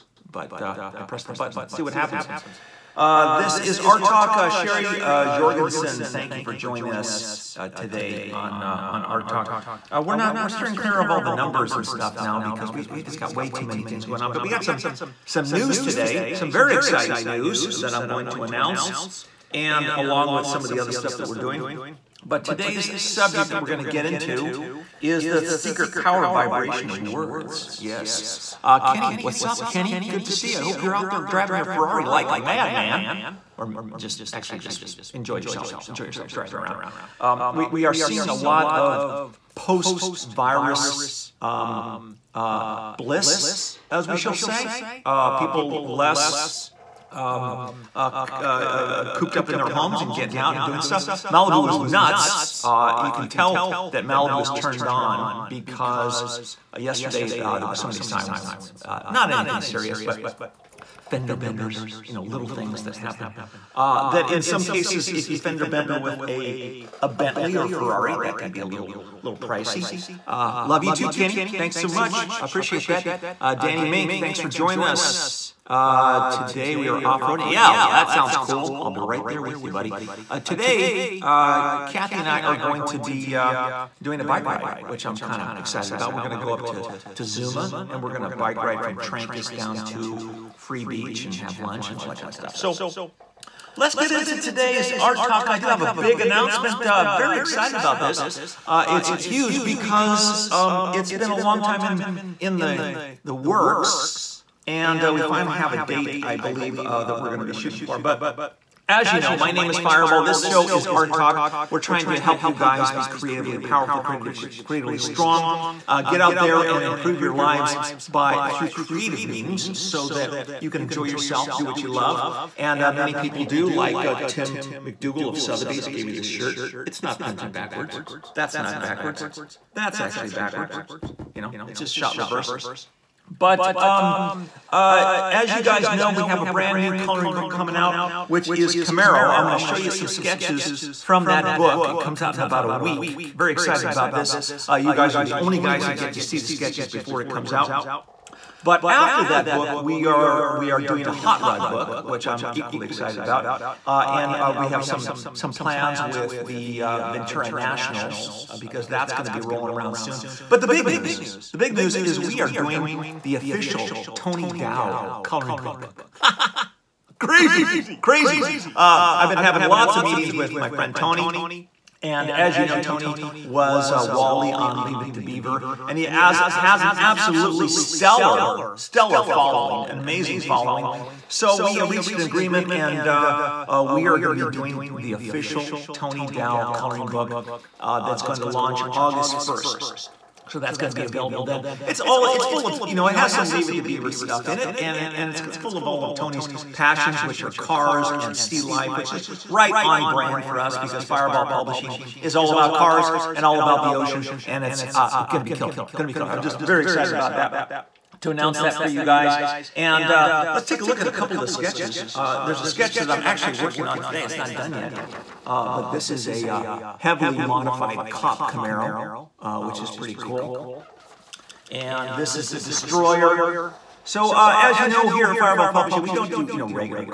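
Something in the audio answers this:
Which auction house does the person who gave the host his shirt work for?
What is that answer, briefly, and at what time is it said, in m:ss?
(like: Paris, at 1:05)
Sotheby's, at 2:05.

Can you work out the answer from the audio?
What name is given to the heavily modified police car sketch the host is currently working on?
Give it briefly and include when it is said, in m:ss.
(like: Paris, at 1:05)
the Destroyer, at 3:42.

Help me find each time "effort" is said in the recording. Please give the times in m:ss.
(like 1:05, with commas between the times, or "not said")
not said.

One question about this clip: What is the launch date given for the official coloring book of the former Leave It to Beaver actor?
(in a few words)
August 1st.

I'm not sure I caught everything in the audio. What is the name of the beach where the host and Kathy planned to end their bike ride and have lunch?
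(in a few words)
Free Beach.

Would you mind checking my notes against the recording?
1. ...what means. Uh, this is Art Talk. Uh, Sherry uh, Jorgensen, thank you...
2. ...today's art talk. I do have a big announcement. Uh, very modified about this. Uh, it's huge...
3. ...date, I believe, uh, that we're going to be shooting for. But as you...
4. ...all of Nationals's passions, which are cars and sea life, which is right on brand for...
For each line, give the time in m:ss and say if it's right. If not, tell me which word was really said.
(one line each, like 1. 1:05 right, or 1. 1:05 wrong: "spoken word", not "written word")
1. 0:01 wrong: "happens", not "means"
2. 1:34 wrong: "excited", not "modified"
3. 1:45 right
4. 3:15 wrong: "Tony", not "Nationals".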